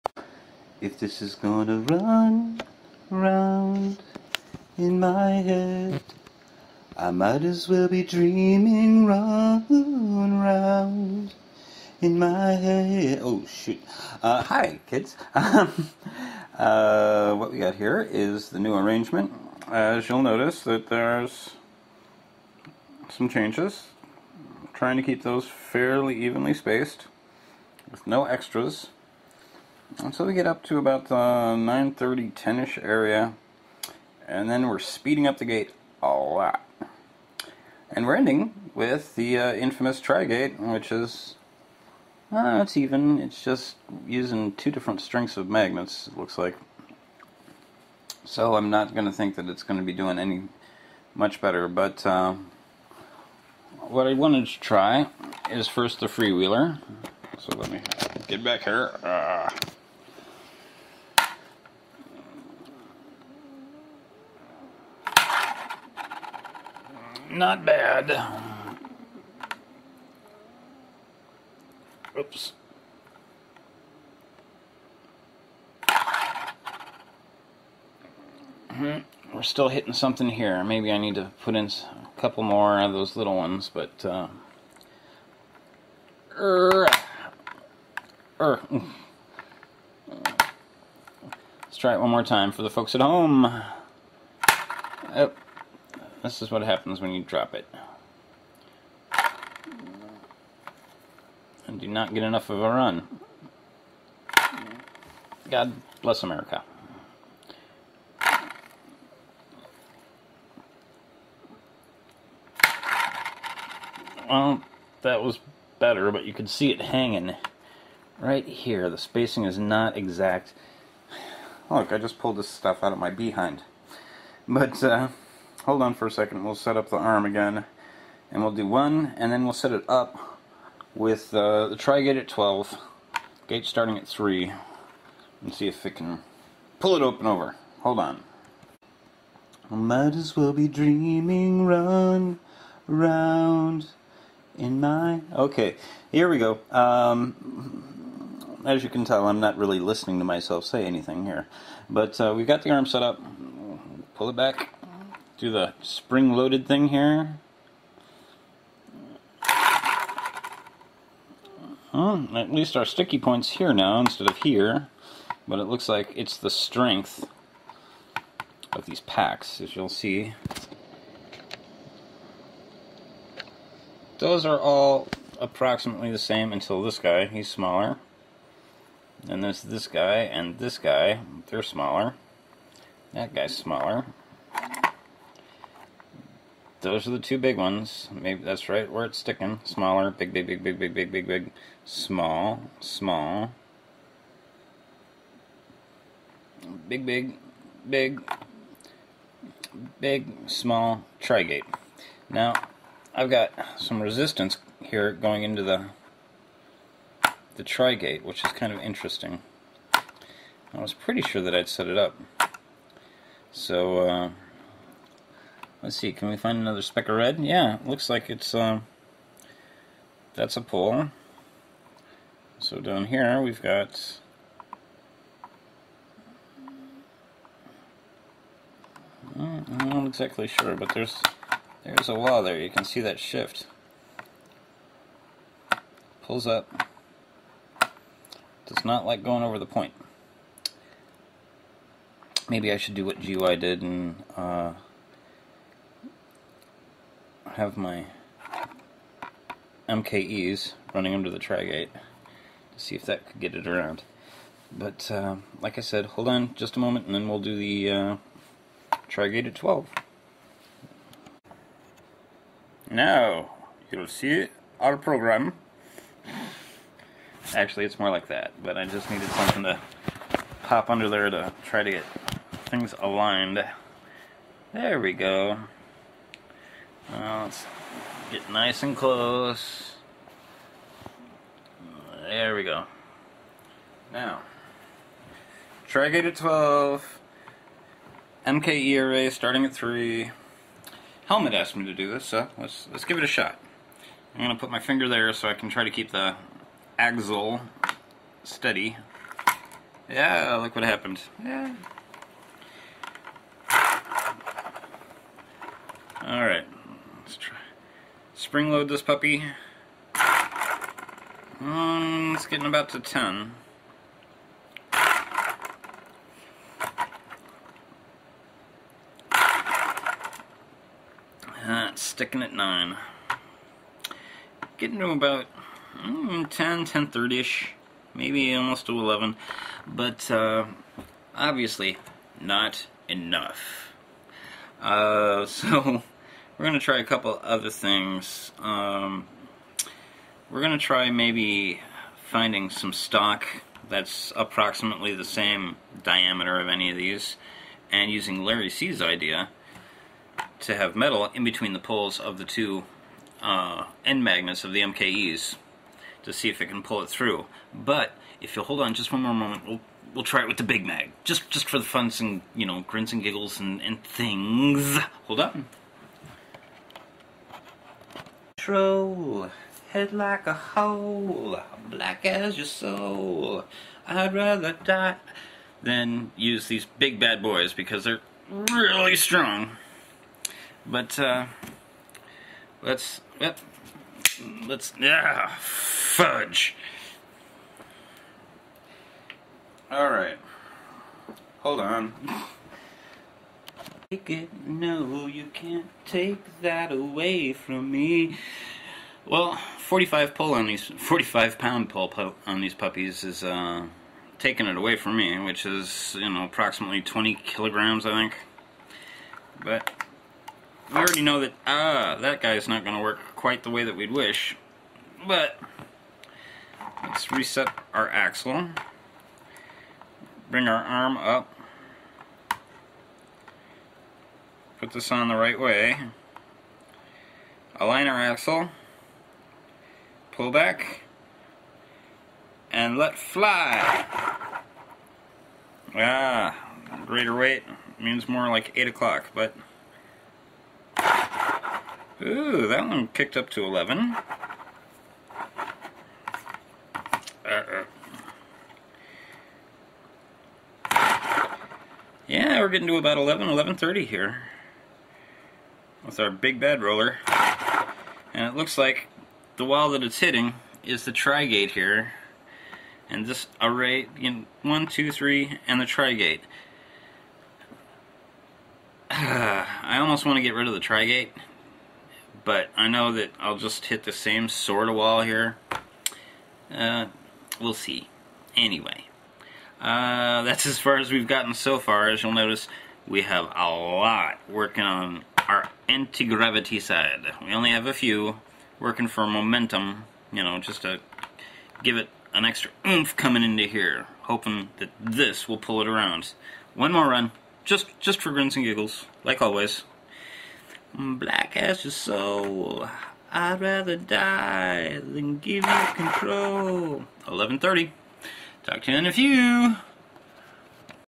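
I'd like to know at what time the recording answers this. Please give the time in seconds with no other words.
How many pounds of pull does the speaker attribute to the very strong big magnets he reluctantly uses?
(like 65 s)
400 s.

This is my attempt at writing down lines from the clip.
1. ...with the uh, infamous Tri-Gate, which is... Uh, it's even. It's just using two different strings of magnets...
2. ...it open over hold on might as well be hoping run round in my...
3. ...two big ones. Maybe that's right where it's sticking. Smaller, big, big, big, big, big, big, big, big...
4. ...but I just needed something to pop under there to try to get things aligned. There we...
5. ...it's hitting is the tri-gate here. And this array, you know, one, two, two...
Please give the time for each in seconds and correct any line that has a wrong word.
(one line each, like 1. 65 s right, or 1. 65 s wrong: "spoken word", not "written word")
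1. 38 s right
2. 136 s wrong: "dreaming", not "hoping"
3. 187 s right
4. 268 s right
5. 460 s wrong: "three", not "two".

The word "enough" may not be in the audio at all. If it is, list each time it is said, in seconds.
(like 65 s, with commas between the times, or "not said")
102 s, 333 s.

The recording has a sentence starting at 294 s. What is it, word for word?
I'm going to put my finger there so I can try to keep the axle steady.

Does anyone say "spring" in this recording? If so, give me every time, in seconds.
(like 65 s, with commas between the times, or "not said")
155 s, 308 s.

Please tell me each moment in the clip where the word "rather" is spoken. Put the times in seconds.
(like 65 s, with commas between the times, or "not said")
374 s, 503 s.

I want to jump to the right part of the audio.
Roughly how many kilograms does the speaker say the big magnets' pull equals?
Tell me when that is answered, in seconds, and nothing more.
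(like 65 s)
407 s.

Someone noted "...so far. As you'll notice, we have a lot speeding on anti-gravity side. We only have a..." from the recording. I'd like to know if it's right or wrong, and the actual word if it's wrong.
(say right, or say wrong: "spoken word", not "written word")
wrong: "working", not "speeding".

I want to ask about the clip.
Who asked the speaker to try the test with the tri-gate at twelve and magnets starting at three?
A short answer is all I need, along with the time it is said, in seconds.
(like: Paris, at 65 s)
Helmet, at 291 s.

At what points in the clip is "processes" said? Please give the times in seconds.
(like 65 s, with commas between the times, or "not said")
not said.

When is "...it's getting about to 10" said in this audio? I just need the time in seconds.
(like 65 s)
312 s.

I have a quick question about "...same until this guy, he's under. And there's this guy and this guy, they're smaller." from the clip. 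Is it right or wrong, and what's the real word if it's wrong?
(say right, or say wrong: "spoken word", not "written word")
wrong: "smaller", not "under".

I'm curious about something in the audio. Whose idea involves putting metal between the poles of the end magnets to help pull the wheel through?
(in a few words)
Larry C.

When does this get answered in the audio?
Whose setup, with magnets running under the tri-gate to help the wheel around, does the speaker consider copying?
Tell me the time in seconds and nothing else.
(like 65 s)
243 s.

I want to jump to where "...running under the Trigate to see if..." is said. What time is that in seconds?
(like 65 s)
250 s.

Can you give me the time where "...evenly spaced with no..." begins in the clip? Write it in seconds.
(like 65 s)
26 s.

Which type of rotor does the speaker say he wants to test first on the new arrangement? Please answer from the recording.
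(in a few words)
freewheeler.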